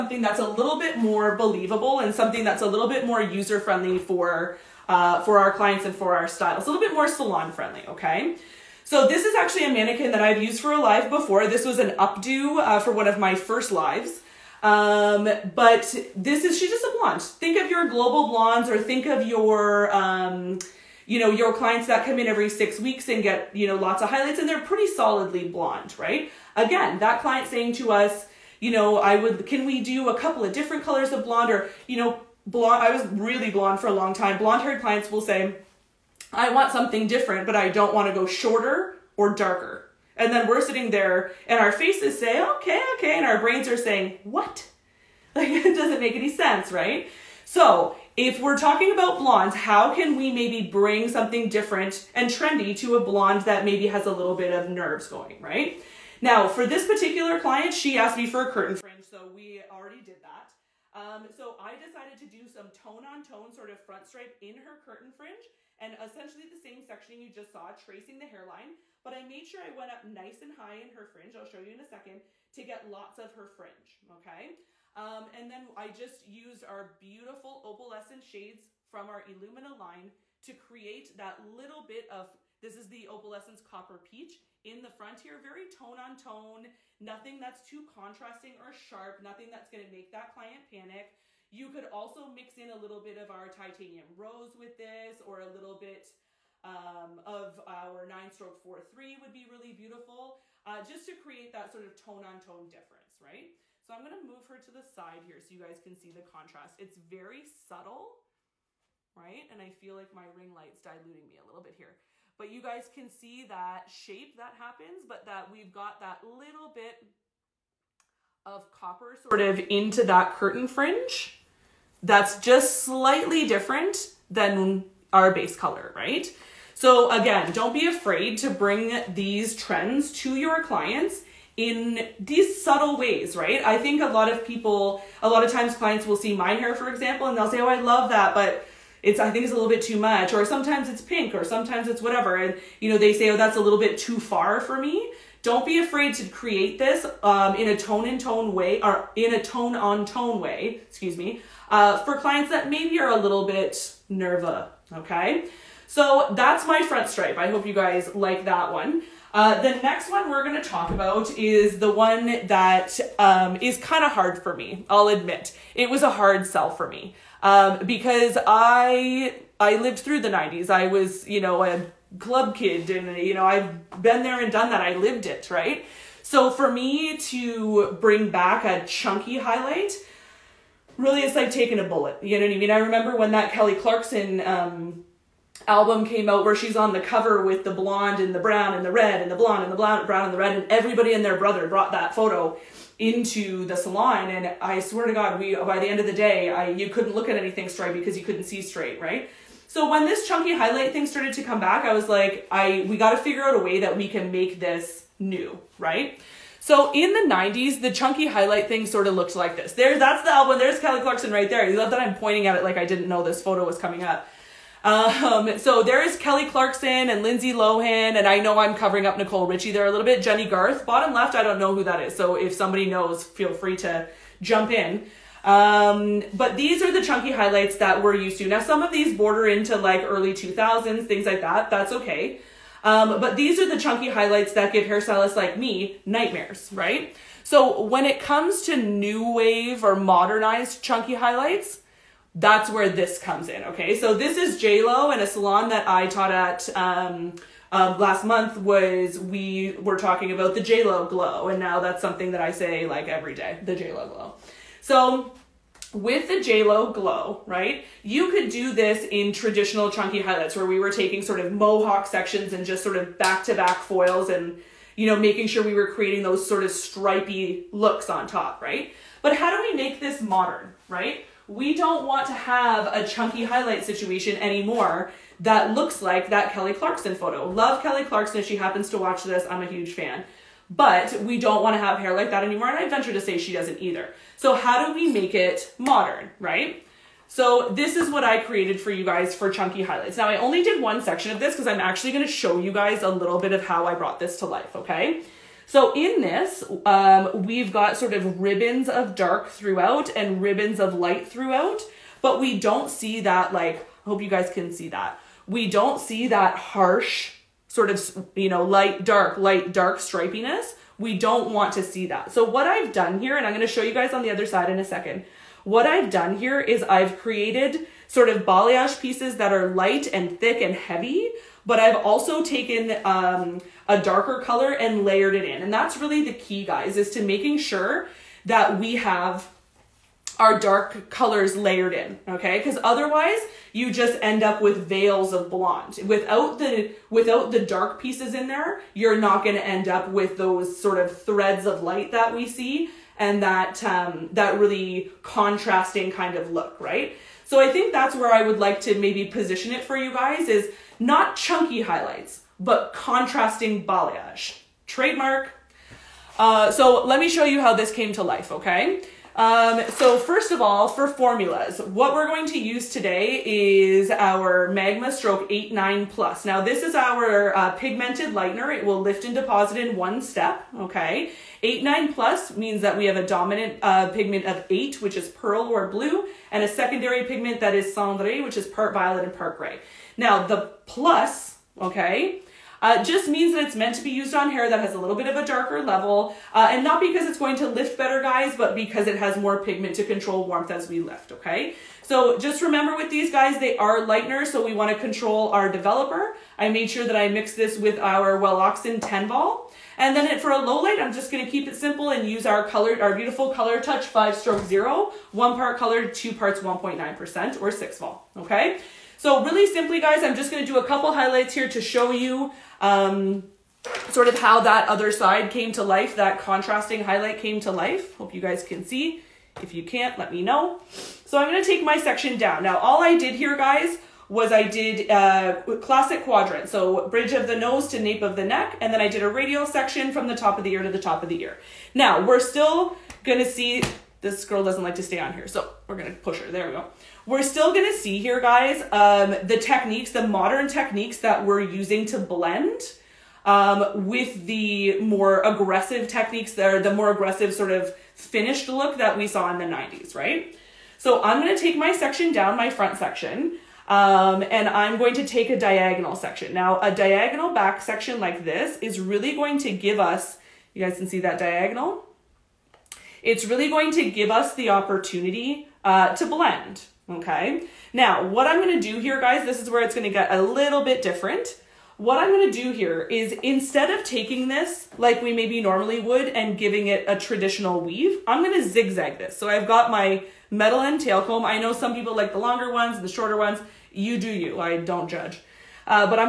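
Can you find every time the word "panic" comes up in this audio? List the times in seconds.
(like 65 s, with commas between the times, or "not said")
90 s.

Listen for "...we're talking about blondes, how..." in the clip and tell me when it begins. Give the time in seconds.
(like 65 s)
48 s.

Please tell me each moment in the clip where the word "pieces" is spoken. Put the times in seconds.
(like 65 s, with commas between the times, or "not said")
318 s, 338 s.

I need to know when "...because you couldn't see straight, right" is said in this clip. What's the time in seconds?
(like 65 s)
197 s.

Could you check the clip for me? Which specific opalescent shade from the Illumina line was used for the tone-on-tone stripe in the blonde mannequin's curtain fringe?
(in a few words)
Opalescence copper peach.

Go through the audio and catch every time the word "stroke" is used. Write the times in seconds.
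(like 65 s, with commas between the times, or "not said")
98 s, 365 s, 404 s.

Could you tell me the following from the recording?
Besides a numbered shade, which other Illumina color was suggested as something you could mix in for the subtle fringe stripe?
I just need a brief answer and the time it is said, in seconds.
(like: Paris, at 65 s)
Titanium rose, at 93 s.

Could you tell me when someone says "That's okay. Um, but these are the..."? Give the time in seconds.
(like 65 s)
231 s.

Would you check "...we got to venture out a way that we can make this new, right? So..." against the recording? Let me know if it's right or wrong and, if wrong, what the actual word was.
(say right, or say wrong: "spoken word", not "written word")
wrong: "figure", not "venture".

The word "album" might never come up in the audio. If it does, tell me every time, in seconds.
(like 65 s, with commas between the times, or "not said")
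185 s, 210 s.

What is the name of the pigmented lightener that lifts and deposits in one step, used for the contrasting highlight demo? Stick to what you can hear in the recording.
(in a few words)
Magma.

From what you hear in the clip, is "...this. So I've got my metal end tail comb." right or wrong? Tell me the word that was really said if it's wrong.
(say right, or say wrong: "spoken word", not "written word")
right.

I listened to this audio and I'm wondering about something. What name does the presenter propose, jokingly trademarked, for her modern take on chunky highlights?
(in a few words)
Contrasting balayage.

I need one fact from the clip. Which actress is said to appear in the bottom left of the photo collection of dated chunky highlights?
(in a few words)
Jennie Garth.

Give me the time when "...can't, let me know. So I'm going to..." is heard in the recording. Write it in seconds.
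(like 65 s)
419 s.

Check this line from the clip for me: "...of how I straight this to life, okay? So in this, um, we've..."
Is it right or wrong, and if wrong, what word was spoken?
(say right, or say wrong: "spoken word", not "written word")
wrong: "brought", not "straight".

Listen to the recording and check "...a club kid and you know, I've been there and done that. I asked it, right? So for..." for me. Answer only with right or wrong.
wrong.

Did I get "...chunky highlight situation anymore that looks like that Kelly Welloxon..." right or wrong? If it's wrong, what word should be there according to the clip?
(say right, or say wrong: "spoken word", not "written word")
wrong: "Clarkson", not "Welloxon".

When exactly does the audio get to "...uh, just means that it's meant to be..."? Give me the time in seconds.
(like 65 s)
382 s.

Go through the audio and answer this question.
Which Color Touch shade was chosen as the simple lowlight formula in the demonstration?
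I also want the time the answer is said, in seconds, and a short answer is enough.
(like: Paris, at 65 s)
5/0, at 404 s.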